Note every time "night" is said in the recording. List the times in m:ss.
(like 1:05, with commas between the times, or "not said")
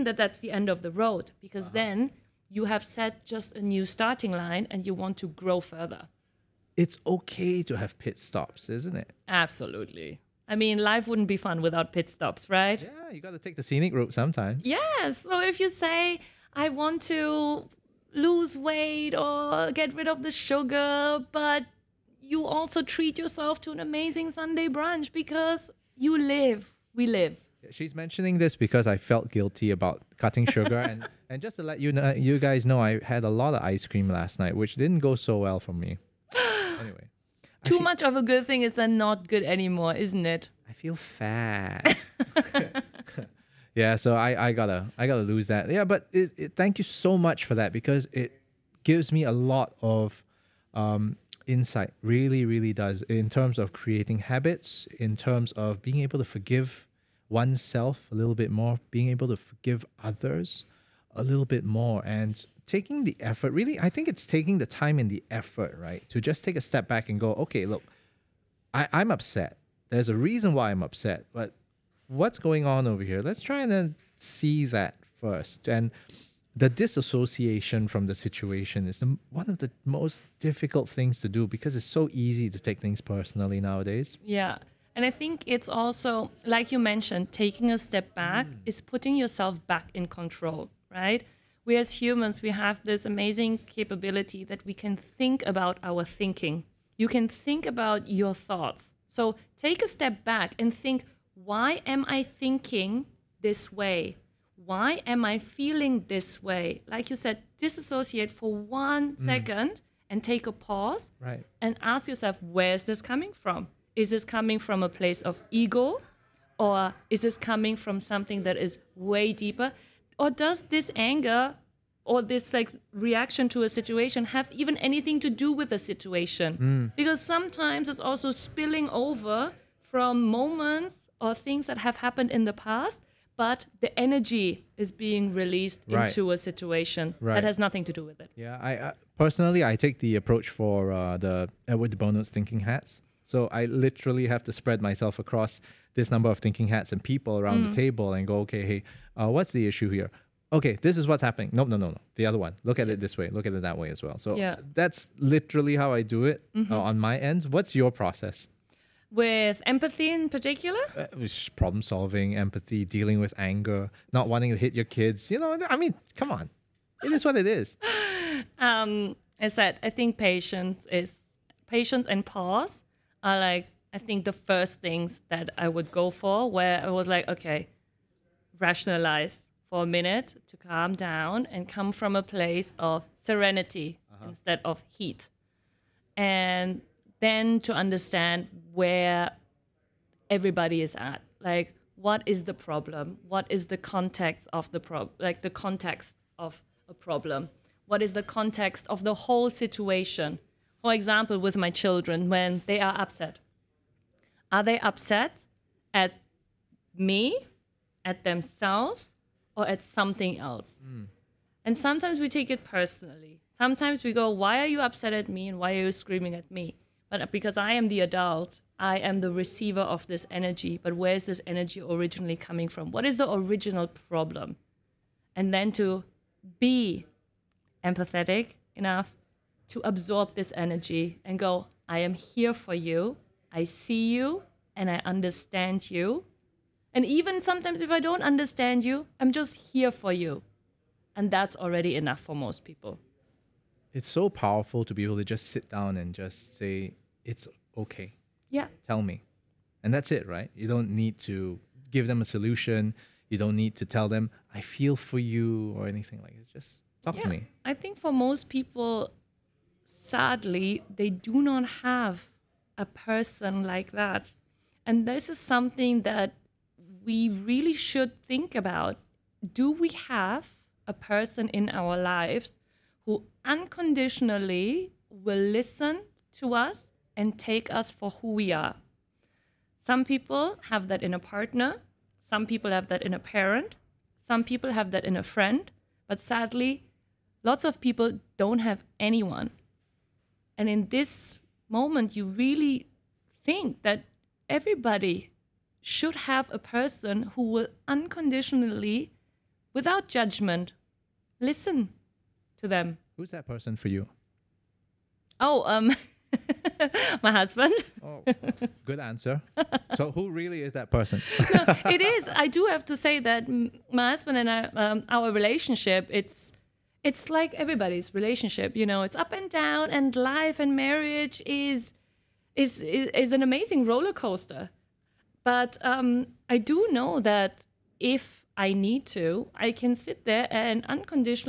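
0:34.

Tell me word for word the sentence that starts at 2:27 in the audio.
the table and go, okay, hey, uh, what's the issue here?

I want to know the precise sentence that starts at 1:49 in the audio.
second and take a pause right.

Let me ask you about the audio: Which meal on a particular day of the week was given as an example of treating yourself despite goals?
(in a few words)
Sunday brunch.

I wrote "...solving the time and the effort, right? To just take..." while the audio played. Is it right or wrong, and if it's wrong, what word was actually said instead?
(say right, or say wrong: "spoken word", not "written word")
wrong: "taking", not "solving".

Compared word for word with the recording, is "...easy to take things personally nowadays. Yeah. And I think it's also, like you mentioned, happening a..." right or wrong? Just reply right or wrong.
wrong.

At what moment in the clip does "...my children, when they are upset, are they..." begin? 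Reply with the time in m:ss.
3:21.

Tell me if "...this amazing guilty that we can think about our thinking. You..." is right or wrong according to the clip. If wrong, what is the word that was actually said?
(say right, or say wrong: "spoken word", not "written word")
wrong: "capability", not "guilty".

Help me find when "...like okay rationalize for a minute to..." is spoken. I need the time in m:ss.
2:57.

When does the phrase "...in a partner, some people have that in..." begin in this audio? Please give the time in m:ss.
4:41.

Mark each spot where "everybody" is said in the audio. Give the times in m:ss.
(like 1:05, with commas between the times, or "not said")
3:10, 4:54, 5:17.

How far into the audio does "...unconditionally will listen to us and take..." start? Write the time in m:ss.
4:33.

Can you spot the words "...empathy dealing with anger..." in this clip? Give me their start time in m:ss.
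2:42.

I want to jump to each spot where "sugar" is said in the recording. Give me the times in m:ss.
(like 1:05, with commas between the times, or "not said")
0:20, 0:30.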